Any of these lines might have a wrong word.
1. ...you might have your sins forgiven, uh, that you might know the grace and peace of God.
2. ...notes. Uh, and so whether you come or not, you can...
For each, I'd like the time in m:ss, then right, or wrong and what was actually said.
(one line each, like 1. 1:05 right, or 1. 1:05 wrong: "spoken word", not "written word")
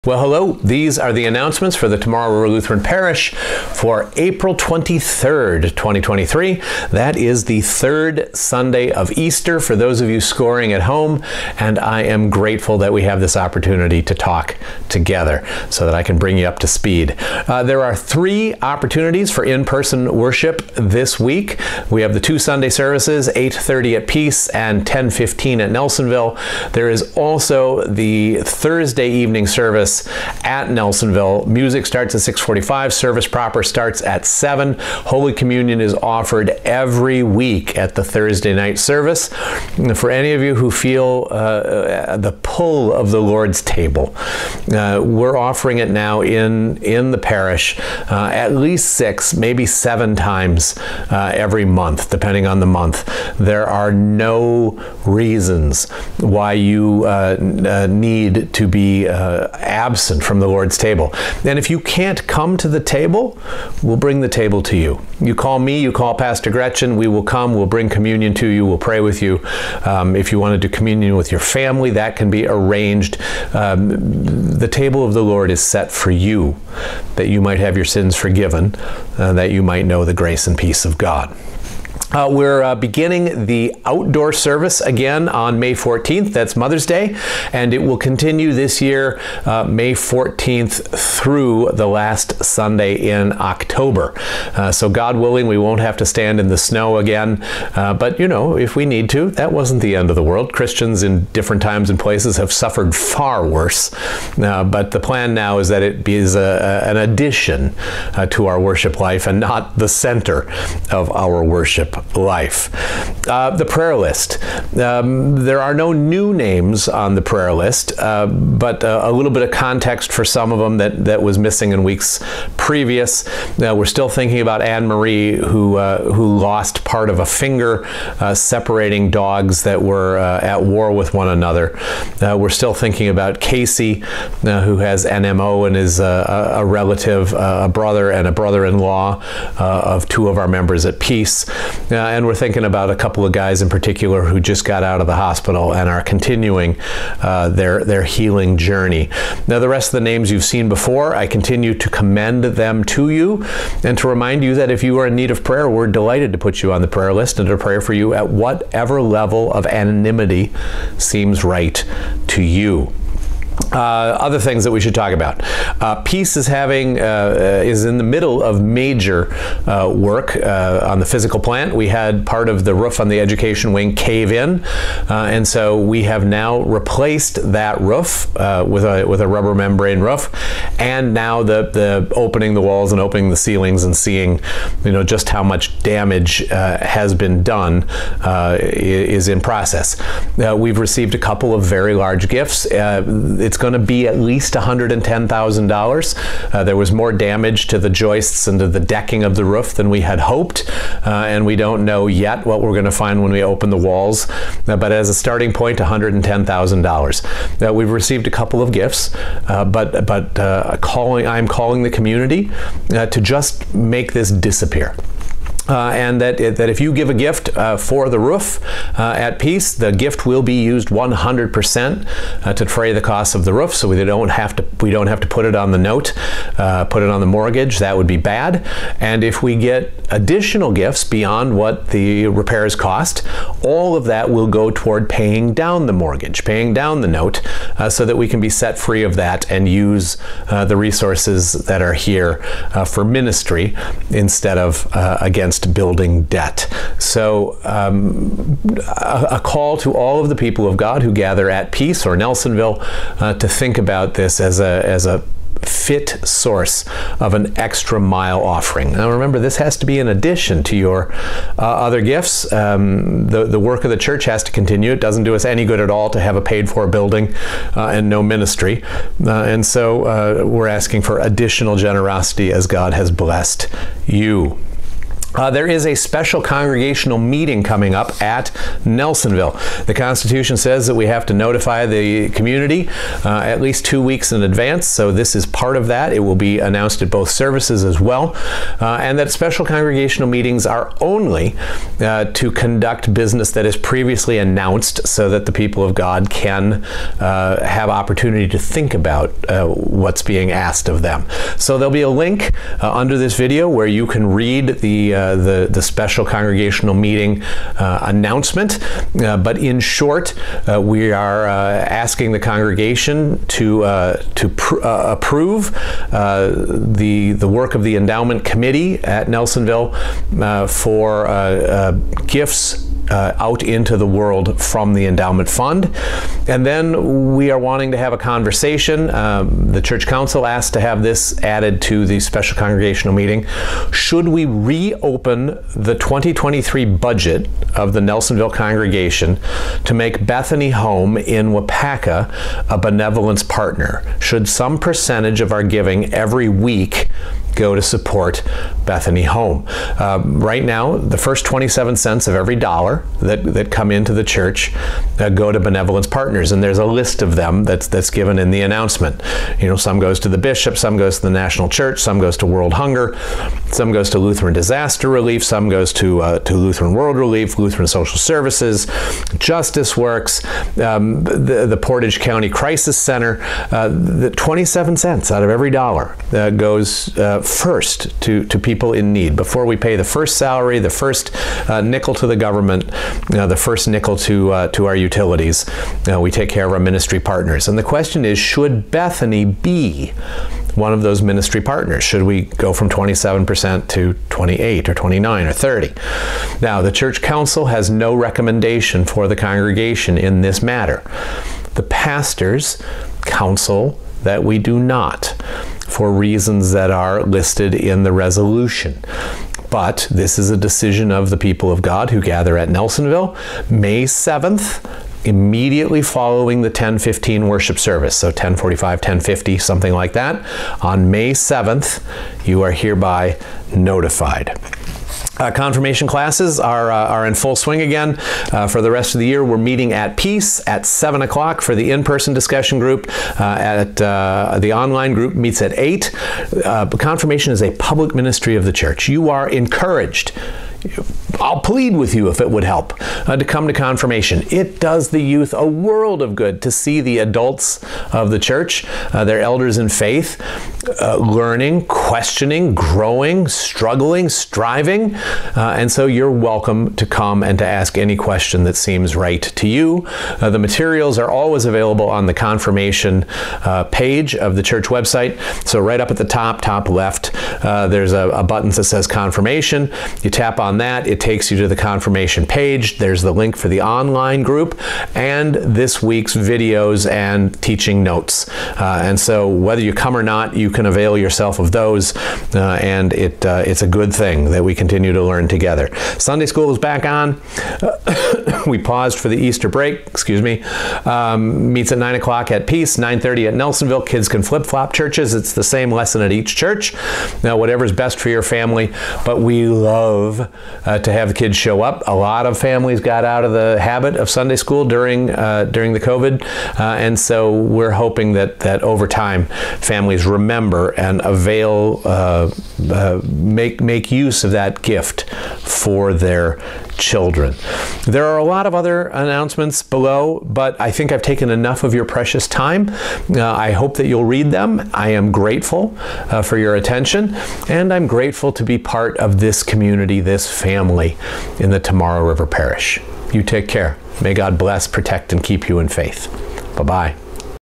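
1. 1:17 right
2. 7:58 right.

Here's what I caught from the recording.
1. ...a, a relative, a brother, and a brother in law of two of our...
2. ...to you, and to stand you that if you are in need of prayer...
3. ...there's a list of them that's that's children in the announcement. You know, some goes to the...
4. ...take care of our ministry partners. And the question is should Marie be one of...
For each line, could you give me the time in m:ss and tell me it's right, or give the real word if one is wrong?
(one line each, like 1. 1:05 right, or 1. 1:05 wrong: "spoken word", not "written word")
1. 2:15 right
2. 2:32 wrong: "remind", not "stand"
3. 5:56 wrong: "given", not "children"
4. 6:26 wrong: "Bethany", not "Marie".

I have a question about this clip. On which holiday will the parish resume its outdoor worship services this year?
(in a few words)
Mother's Day.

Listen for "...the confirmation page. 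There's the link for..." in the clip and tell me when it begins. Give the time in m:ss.
7:51.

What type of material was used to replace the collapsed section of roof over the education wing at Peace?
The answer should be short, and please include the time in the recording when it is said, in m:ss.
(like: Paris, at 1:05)
rubber membrane, at 2:59.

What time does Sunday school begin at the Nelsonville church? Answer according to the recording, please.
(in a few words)
9:30.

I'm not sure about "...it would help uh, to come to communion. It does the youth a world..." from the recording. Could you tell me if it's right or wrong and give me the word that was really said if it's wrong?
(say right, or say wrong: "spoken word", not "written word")
wrong: "confirmation", not "communion".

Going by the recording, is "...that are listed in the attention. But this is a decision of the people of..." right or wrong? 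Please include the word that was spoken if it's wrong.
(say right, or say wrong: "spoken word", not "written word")
wrong: "resolution", not "attention".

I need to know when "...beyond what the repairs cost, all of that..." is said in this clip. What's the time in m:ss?
3:51.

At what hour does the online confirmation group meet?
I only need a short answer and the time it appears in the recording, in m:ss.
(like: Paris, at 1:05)
8, at 7:15.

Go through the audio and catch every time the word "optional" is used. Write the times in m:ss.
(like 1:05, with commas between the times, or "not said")
not said.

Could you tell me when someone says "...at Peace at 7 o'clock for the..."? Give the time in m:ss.
7:09.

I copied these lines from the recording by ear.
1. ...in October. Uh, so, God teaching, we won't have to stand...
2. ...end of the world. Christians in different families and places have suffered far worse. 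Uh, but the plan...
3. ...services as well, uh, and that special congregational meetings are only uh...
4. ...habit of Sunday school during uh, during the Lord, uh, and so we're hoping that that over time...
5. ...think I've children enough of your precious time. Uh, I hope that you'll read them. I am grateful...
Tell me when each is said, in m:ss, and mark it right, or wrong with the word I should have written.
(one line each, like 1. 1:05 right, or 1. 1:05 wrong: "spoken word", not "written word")
1. 1:32 wrong: "willing", not "teaching"
2. 1:39 wrong: "times", not "families"
3. 4:47 right
4. 8:23 wrong: "COVID", not "Lord"
5. 8:40 wrong: "taken", not "children".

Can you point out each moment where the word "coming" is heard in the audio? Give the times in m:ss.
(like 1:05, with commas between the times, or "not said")
4:37.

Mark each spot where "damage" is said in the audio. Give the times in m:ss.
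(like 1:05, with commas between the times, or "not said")
3:05, 3:17.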